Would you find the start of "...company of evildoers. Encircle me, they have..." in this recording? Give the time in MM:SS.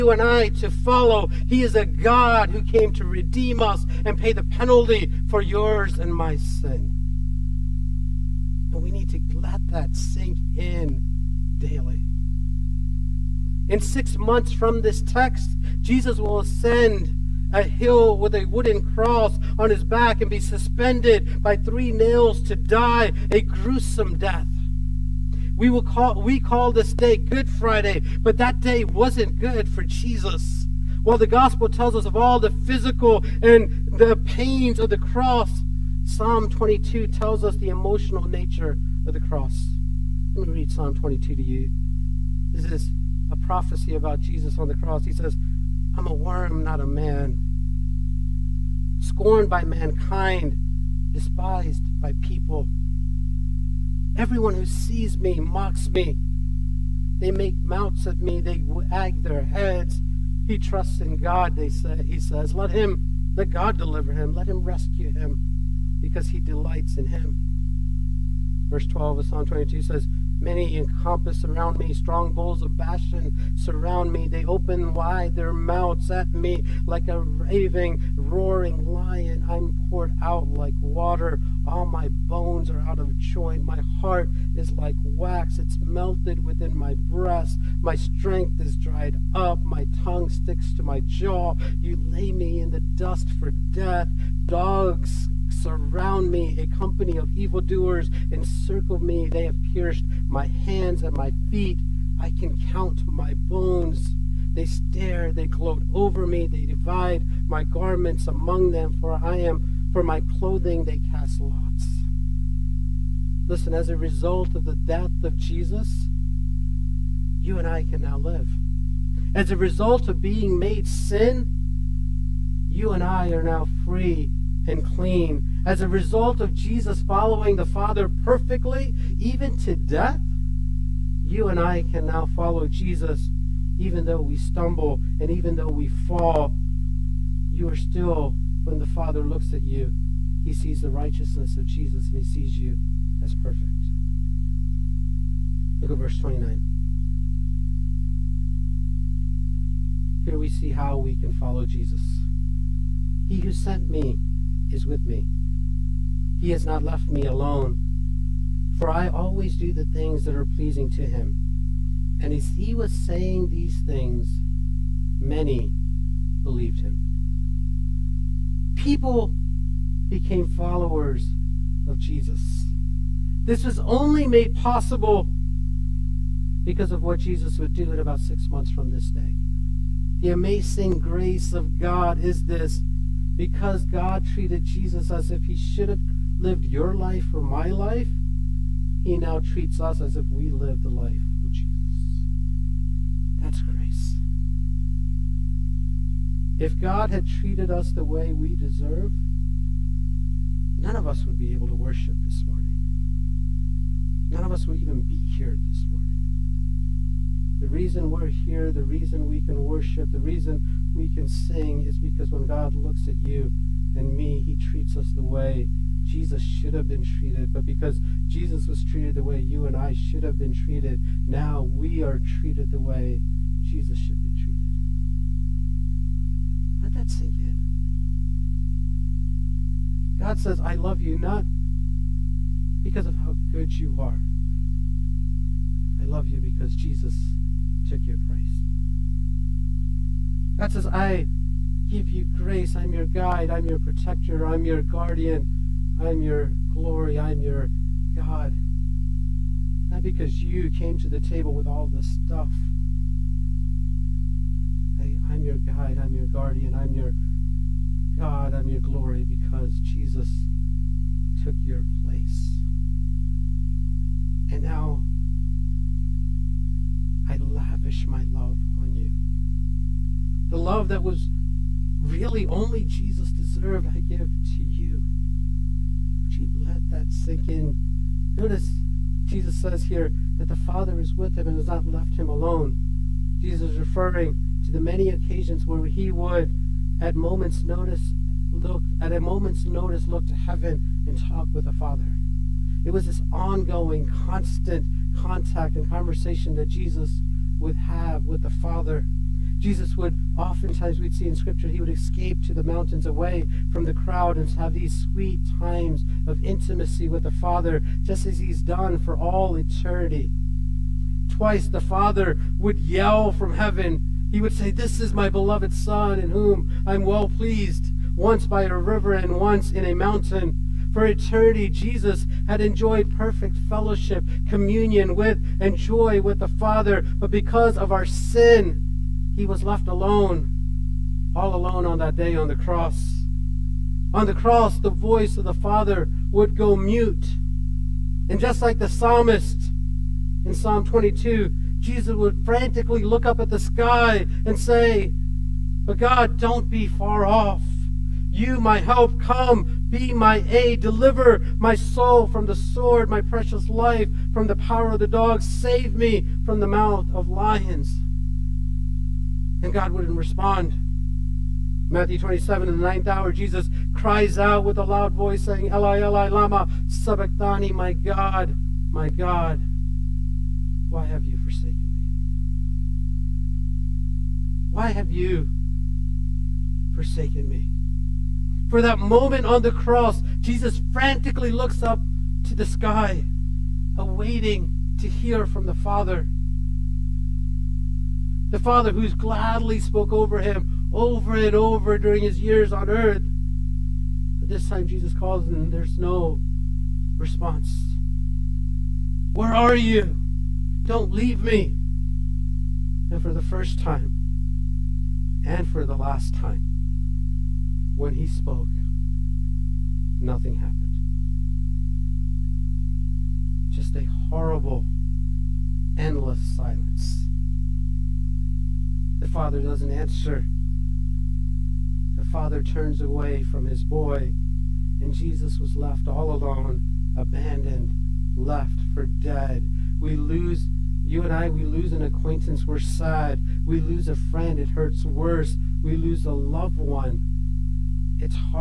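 01:36.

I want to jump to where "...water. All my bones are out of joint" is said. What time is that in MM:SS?
01:20.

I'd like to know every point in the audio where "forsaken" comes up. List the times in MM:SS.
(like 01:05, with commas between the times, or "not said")
06:11, 06:16.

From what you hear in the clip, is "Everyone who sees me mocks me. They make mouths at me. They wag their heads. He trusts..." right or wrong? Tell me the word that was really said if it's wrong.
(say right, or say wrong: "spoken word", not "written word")
right.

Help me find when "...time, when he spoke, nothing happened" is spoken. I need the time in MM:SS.
06:46.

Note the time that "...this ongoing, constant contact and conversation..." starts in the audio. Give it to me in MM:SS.
04:53.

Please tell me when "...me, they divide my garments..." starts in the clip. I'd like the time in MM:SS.
01:46.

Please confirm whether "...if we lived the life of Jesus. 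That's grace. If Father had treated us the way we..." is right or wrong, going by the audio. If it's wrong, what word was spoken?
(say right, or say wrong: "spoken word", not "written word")
wrong: "God", not "Father".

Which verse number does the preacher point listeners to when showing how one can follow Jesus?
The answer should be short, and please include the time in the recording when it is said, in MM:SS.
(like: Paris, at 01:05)
Verse 29, at 02:25.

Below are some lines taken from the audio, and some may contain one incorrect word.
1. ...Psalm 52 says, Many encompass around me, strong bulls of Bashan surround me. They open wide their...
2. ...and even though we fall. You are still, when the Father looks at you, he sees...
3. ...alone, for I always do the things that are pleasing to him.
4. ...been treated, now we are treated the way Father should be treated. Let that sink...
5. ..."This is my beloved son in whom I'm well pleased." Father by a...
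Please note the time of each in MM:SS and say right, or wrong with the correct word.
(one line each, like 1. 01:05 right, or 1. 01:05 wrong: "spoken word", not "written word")
1. 01:09 wrong: "22", not "52"
2. 02:15 right
3. 02:37 right
4. 03:40 wrong: "Jesus", not "Father"
5. 05:14 wrong: "Once", not "Father".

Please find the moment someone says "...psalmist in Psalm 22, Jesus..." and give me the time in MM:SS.
05:38.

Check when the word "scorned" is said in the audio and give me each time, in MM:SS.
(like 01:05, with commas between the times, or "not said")
00:48.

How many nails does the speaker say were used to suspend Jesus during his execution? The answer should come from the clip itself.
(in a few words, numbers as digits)
3.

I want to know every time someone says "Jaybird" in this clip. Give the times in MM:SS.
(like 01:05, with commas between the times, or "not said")
not said.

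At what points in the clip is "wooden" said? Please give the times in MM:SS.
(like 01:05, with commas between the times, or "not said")
00:18.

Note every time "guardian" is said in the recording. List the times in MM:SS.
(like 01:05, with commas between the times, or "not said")
04:04, 04:16.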